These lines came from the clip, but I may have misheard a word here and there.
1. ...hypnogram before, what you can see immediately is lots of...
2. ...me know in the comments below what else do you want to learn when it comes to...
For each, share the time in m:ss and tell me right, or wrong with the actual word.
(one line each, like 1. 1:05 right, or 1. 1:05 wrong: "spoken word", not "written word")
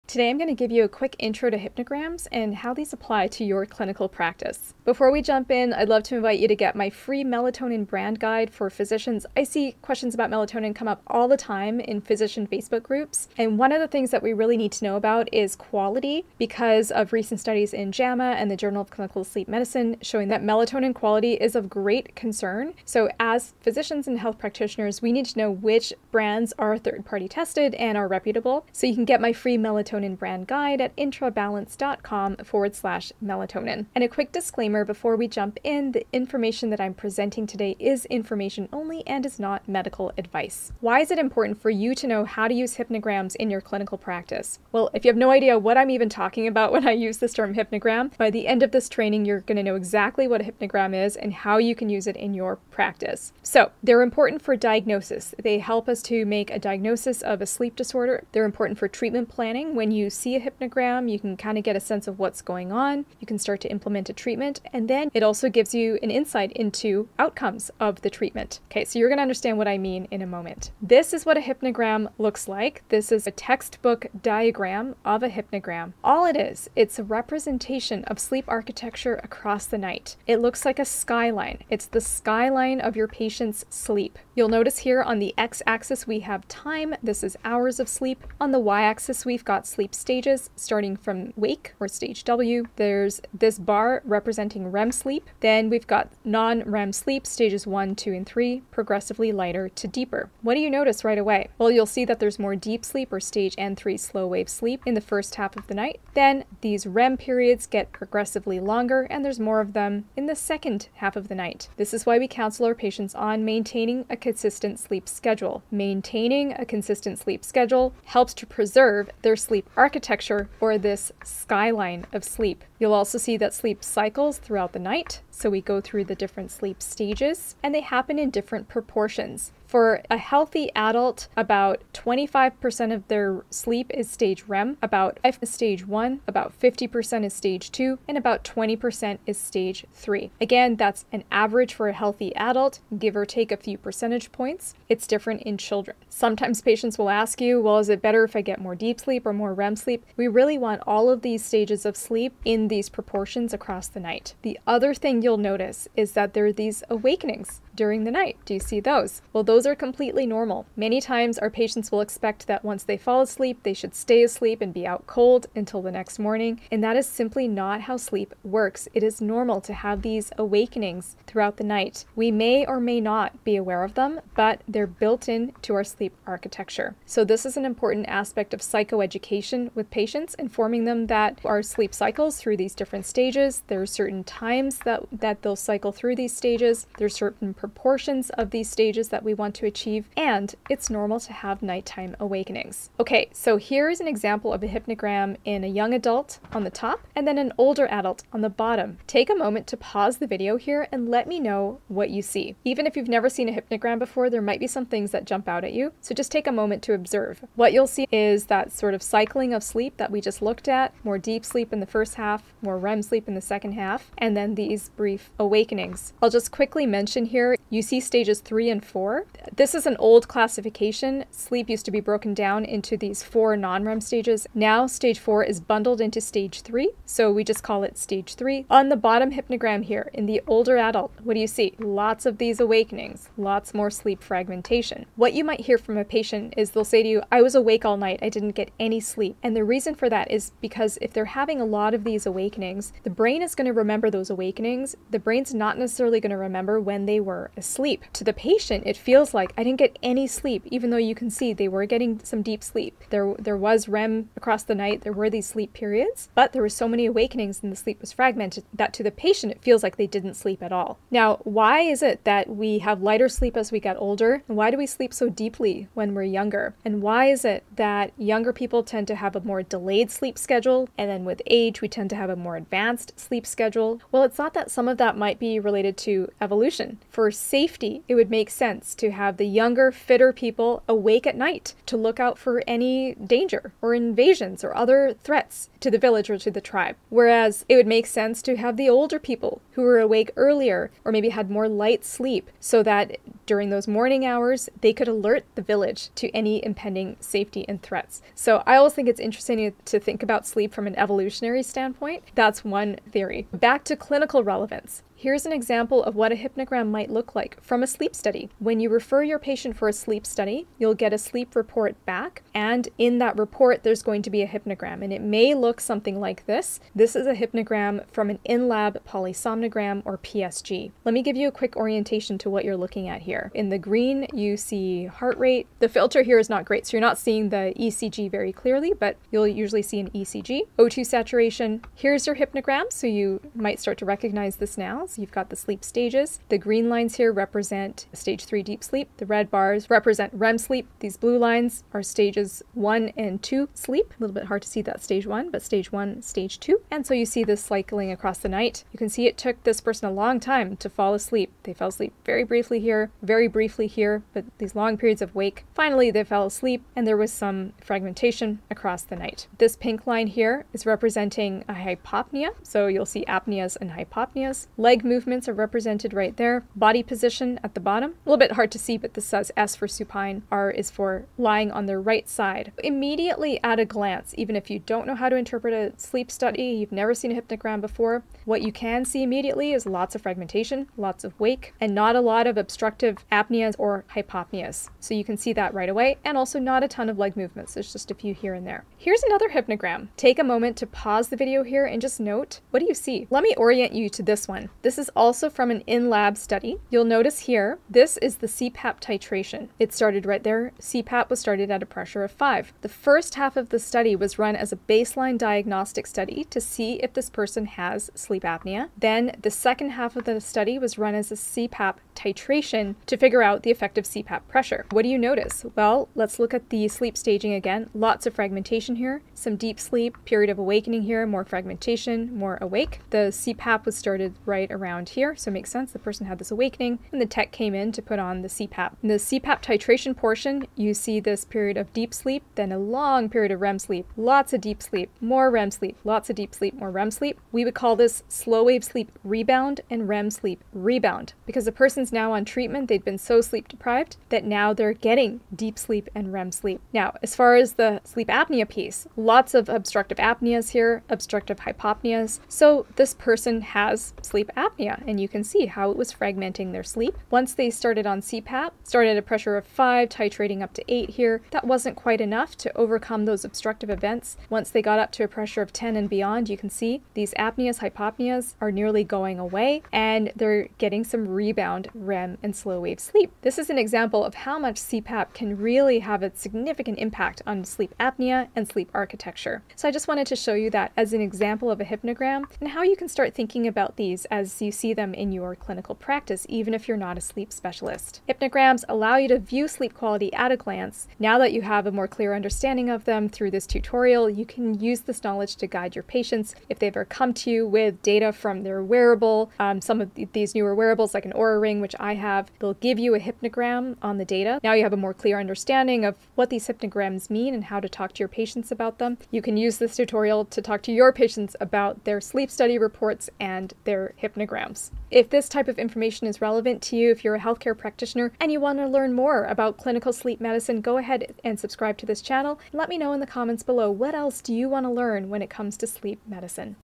1. 6:17 right
2. 8:42 right.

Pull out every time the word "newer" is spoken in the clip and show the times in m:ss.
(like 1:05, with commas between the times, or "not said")
8:20.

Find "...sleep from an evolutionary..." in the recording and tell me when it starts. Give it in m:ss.
5:00.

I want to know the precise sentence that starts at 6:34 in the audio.
This is also from an in-lab study.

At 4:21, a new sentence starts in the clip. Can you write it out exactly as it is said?
Now, why is it that we have lighter sleep as we get older?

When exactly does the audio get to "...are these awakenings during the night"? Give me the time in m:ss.
2:36.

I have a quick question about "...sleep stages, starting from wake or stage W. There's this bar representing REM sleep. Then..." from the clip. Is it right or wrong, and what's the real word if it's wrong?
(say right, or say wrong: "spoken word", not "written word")
right.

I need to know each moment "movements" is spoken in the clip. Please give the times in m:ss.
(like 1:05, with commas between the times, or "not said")
6:05, 6:27.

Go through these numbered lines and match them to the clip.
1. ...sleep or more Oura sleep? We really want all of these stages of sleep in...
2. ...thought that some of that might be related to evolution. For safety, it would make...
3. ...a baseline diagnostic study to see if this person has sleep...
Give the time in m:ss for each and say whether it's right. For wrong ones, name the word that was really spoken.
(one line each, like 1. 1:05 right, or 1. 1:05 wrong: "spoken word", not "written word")
1. 2:28 wrong: "REM", not "Oura"
2. 4:34 right
3. 6:44 right.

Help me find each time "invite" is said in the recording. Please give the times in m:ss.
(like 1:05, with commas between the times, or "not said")
0:06.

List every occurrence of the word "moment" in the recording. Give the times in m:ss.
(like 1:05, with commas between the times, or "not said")
1:10, 3:19, 3:26, 6:30.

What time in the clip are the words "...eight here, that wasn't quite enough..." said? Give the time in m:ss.
7:40.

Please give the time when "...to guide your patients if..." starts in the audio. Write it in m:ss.
8:15.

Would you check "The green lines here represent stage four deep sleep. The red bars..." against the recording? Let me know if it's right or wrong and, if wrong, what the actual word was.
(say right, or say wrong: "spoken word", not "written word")
wrong: "three", not "four".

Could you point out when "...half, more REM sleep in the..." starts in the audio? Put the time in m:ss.
3:32.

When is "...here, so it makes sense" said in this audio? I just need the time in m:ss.
7:05.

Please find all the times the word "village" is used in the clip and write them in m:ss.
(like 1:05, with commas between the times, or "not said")
4:45, 4:55.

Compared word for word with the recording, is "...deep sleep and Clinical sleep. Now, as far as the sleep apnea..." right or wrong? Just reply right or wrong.
wrong.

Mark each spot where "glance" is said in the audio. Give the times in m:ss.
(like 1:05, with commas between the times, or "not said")
6:13, 8:10.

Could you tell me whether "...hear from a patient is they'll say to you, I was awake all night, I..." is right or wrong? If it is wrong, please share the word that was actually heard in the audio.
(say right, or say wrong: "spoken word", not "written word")
right.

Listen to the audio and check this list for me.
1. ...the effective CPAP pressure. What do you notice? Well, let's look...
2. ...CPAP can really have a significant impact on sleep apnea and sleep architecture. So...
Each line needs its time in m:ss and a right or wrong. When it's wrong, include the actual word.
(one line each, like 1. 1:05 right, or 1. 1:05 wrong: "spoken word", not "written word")
1. 6:53 right
2. 7:54 right.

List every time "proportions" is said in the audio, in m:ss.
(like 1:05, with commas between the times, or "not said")
2:08, 2:32, 3:07.